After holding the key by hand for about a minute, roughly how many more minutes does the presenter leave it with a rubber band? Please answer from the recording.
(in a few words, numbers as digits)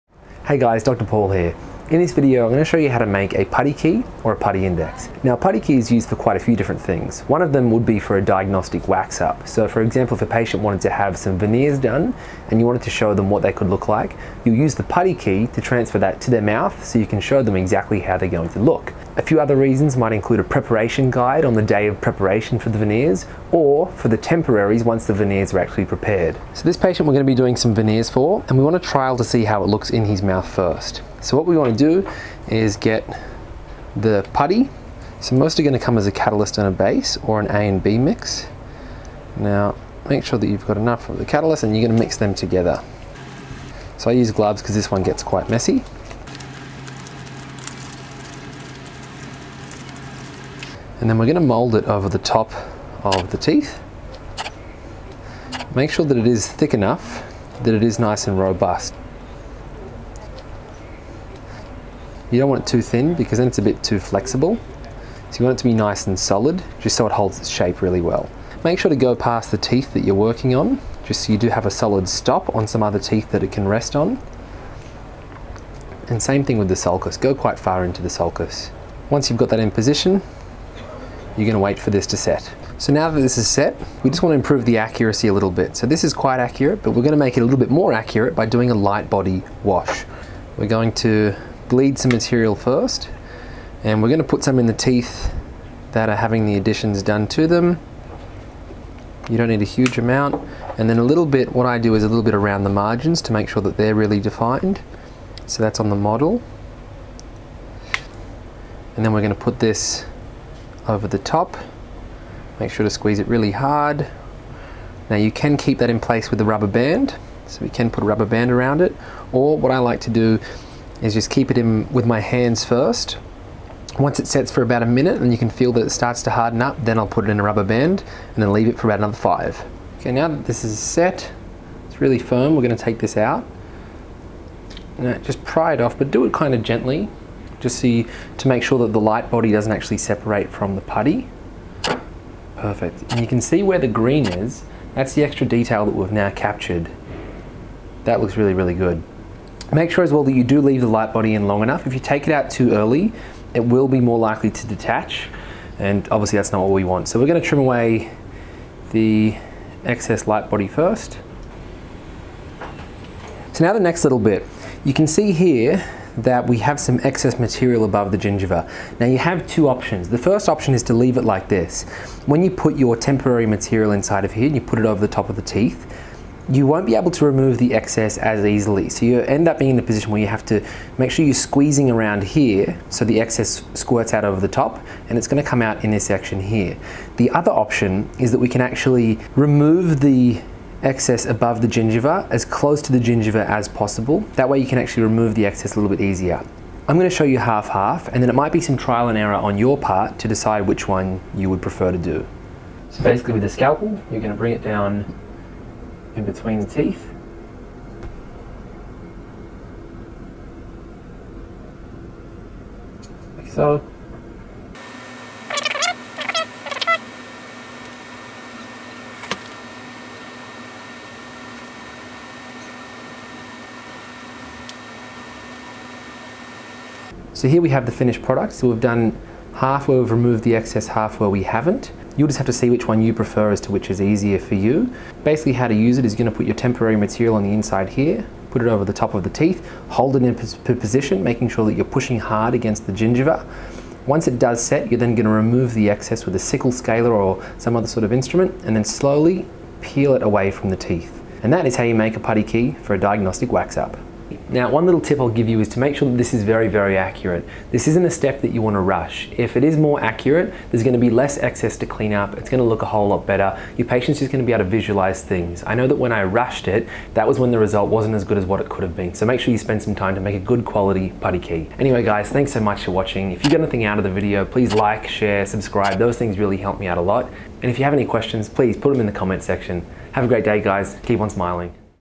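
5.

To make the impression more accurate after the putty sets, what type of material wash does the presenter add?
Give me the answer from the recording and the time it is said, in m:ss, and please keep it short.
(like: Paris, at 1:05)
Light body wash, at 1:28.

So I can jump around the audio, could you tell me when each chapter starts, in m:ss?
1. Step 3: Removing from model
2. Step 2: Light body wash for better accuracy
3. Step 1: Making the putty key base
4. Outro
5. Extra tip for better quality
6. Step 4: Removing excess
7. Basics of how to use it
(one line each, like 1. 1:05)
1. 2:10
2. 1:22
3. 0:27
4. 4:33
5. 4:14
6. 2:36
7. 3:55.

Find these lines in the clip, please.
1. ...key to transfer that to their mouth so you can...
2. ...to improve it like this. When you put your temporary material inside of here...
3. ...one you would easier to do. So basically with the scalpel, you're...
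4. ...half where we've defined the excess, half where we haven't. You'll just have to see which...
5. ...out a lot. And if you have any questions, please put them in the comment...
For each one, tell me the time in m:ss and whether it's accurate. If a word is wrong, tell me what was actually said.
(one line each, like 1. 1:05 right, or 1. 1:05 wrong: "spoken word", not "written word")
1. 0:15 right
2. 2:50 wrong: "leave", not "improve"
3. 3:20 wrong: "prefer", not "easier"
4. 3:49 wrong: "removed", not "defined"
5. 4:36 right.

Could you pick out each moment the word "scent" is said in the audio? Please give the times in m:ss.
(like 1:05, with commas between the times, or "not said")
not said.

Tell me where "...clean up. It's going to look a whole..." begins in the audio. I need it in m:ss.
4:21.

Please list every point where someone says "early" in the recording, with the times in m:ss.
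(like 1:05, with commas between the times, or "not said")
2:32.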